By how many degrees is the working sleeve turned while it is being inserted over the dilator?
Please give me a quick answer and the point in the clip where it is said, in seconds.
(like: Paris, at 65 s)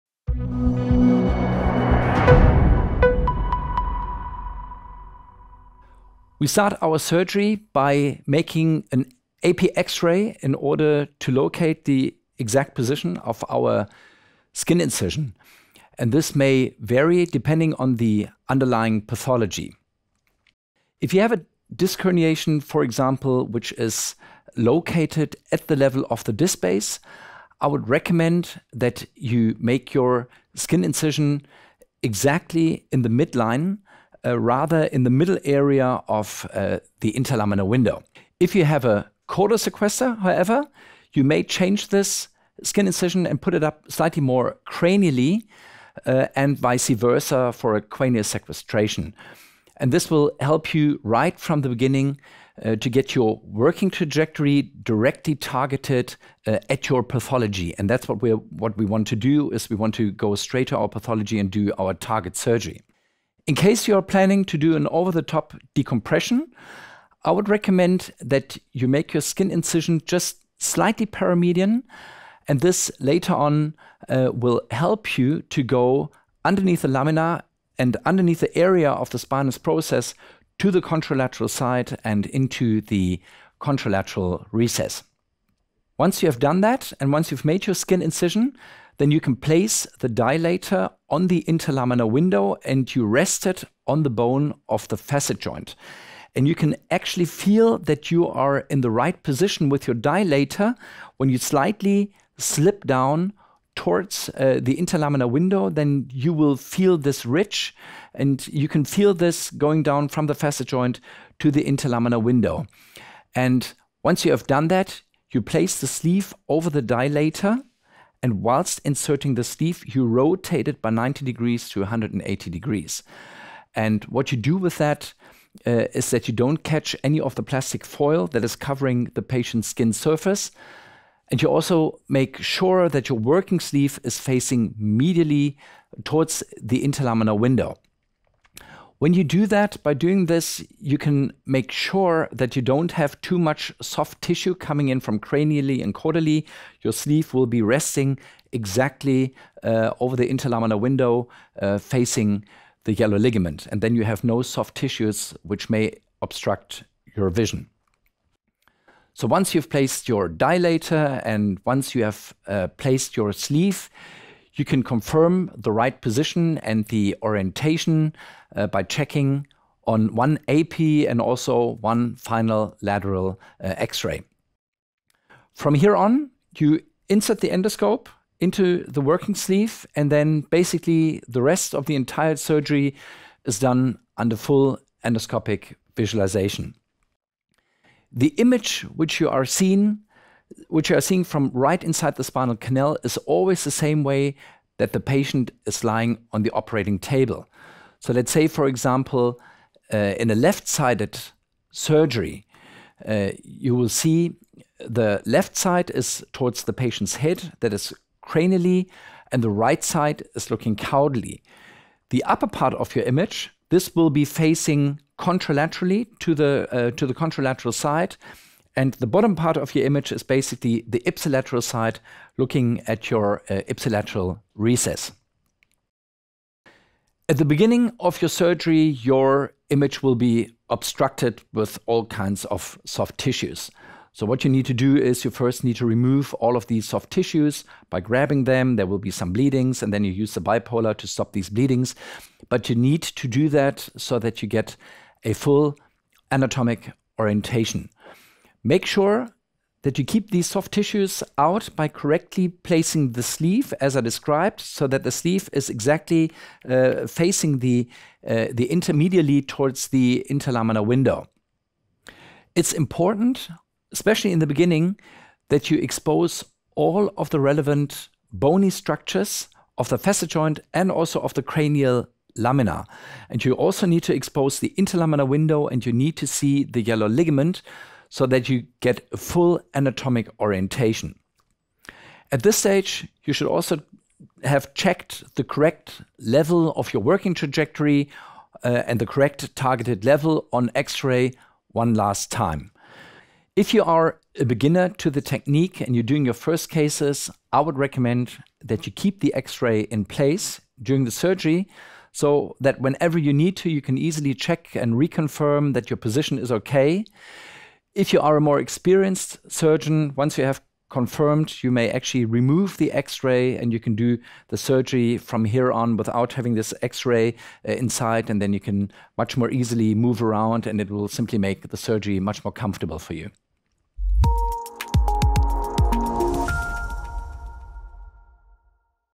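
90 to 180 degrees, at 120 s.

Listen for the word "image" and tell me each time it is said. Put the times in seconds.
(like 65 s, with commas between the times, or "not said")
188 s, 213 s, 219 s, 229 s.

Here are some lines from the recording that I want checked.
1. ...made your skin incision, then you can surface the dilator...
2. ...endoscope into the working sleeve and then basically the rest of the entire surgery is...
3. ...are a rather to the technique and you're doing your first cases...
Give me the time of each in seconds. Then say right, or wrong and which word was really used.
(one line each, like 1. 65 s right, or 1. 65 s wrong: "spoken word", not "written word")
1. 87 s wrong: "place", not "surface"
2. 177 s right
3. 293 s wrong: "beginner", not "rather".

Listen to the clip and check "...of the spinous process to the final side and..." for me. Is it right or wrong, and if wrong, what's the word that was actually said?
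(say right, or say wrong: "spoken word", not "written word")
wrong: "contralateral", not "final".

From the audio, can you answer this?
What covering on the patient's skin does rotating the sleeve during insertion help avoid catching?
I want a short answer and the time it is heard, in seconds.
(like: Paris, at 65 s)
plastic foil, at 127 s.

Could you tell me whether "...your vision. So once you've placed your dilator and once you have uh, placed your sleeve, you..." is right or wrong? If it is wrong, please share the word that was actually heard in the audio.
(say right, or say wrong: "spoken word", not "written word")
right.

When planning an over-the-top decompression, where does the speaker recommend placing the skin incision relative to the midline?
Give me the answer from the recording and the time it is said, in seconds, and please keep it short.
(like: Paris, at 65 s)
slightly paramedian, at 70 s.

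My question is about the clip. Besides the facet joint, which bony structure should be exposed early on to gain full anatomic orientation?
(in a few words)
cranial lamina.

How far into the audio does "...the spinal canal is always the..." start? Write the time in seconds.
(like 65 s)
192 s.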